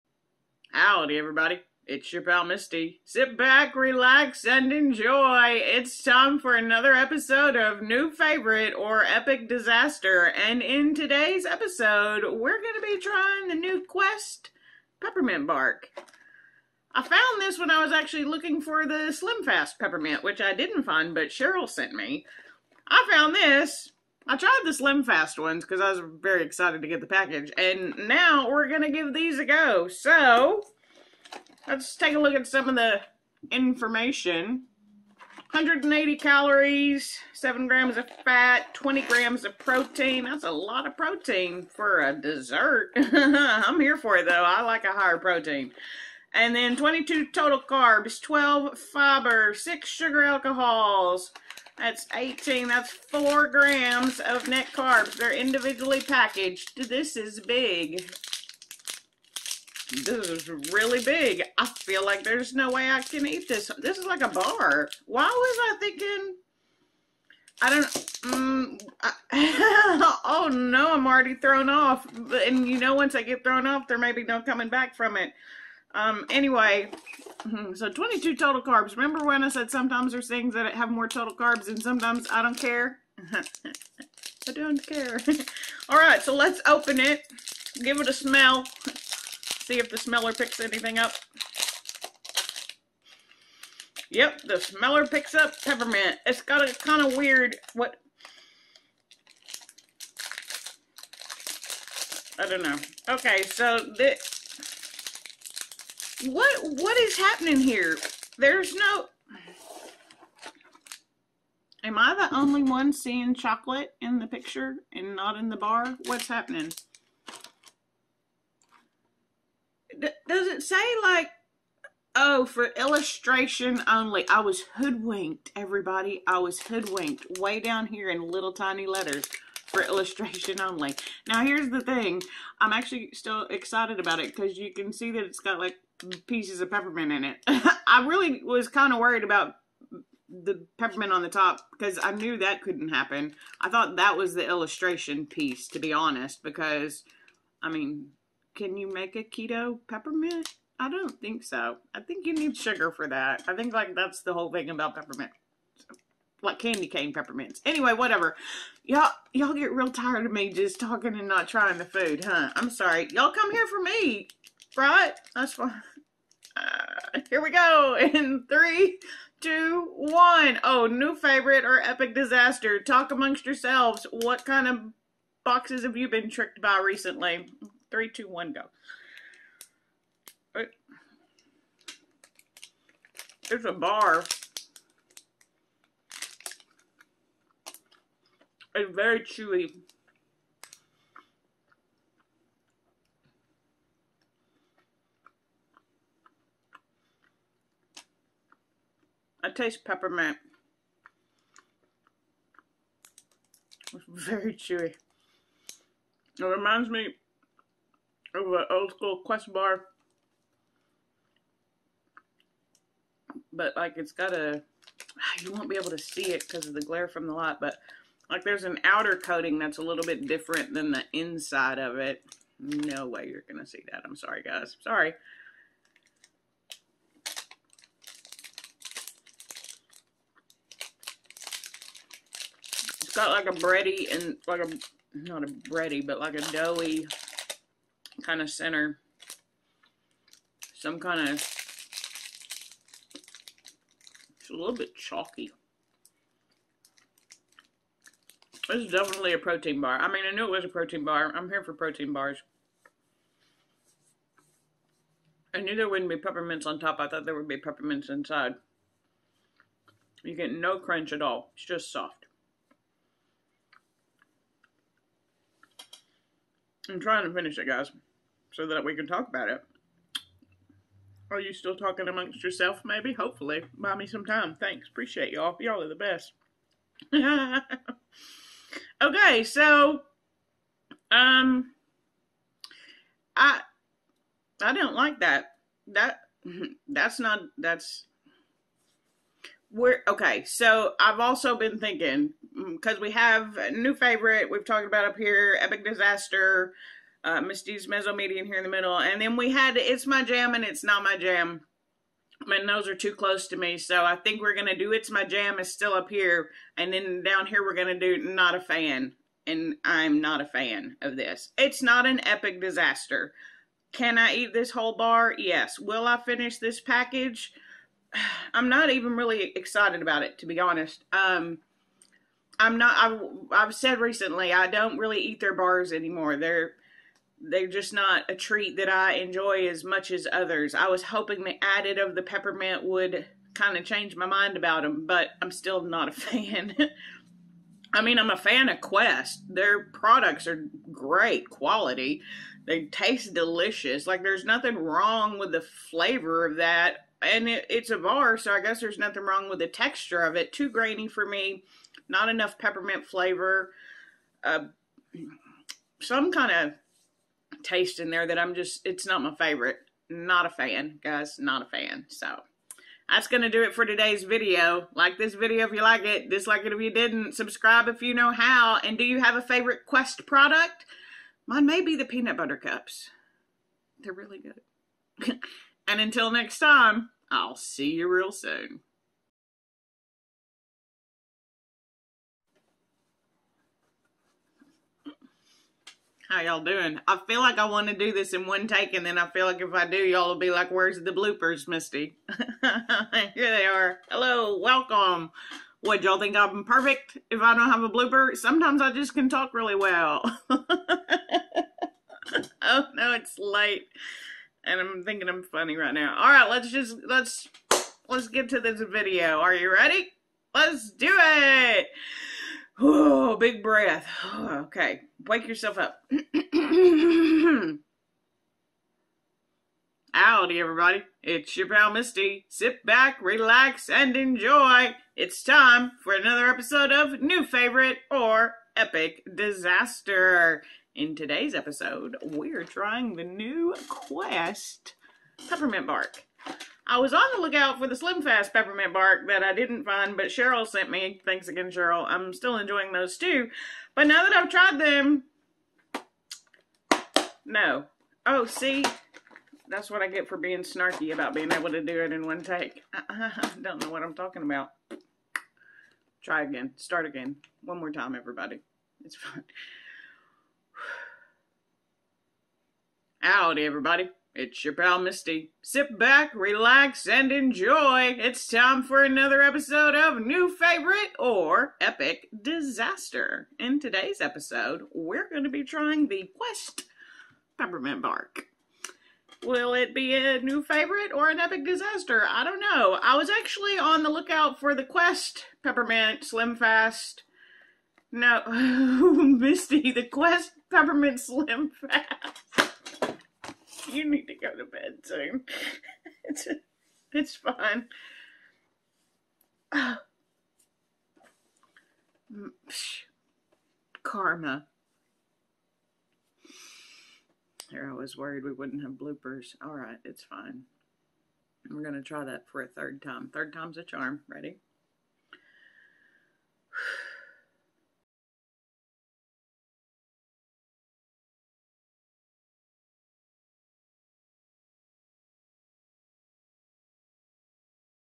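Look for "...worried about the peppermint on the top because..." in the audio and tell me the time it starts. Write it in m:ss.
2:18.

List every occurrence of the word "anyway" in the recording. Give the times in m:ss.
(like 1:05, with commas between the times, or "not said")
1:16, 2:37.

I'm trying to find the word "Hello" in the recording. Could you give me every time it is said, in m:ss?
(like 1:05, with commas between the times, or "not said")
6:34.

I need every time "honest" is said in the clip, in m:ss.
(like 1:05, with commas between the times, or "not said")
2:25, 5:20.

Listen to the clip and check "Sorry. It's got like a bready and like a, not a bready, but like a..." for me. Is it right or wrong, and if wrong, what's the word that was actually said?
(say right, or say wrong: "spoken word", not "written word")
right.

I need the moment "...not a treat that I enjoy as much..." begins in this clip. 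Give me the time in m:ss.
5:27.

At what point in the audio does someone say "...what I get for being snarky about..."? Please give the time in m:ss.
7:29.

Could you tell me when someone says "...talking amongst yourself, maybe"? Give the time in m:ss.
4:31.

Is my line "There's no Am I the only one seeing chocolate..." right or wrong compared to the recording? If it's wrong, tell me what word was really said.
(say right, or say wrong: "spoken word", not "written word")
right.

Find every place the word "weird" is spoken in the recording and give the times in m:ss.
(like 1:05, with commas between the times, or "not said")
1:37.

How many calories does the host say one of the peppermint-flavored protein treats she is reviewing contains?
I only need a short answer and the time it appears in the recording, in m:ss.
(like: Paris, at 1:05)
180, at 0:35.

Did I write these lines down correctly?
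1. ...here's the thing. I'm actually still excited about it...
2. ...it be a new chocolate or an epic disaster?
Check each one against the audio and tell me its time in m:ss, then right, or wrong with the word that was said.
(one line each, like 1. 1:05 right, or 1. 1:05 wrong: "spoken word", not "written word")
1. 2:11 right
2. 7:59 wrong: "favorite", not "chocolate".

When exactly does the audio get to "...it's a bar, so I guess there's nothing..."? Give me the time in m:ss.
5:47.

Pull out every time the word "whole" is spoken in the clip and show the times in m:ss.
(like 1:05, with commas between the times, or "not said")
2:34, 5:14.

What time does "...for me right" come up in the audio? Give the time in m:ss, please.
2:43.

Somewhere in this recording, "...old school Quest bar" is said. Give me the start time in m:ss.
3:28.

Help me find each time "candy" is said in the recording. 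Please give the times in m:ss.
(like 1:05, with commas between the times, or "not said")
2:36.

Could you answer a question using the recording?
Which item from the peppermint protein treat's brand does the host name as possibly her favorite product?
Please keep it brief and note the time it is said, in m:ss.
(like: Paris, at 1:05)
Peanut butter cups, at 6:12.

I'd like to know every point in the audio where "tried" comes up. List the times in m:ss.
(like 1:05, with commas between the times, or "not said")
0:24, 7:24.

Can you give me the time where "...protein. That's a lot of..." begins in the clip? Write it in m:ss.
0:39.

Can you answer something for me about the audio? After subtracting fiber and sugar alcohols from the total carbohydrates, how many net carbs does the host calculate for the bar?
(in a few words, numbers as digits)
4 grams.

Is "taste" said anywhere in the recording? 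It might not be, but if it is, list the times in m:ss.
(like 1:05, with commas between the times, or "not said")
3:19, 5:42, 5:57.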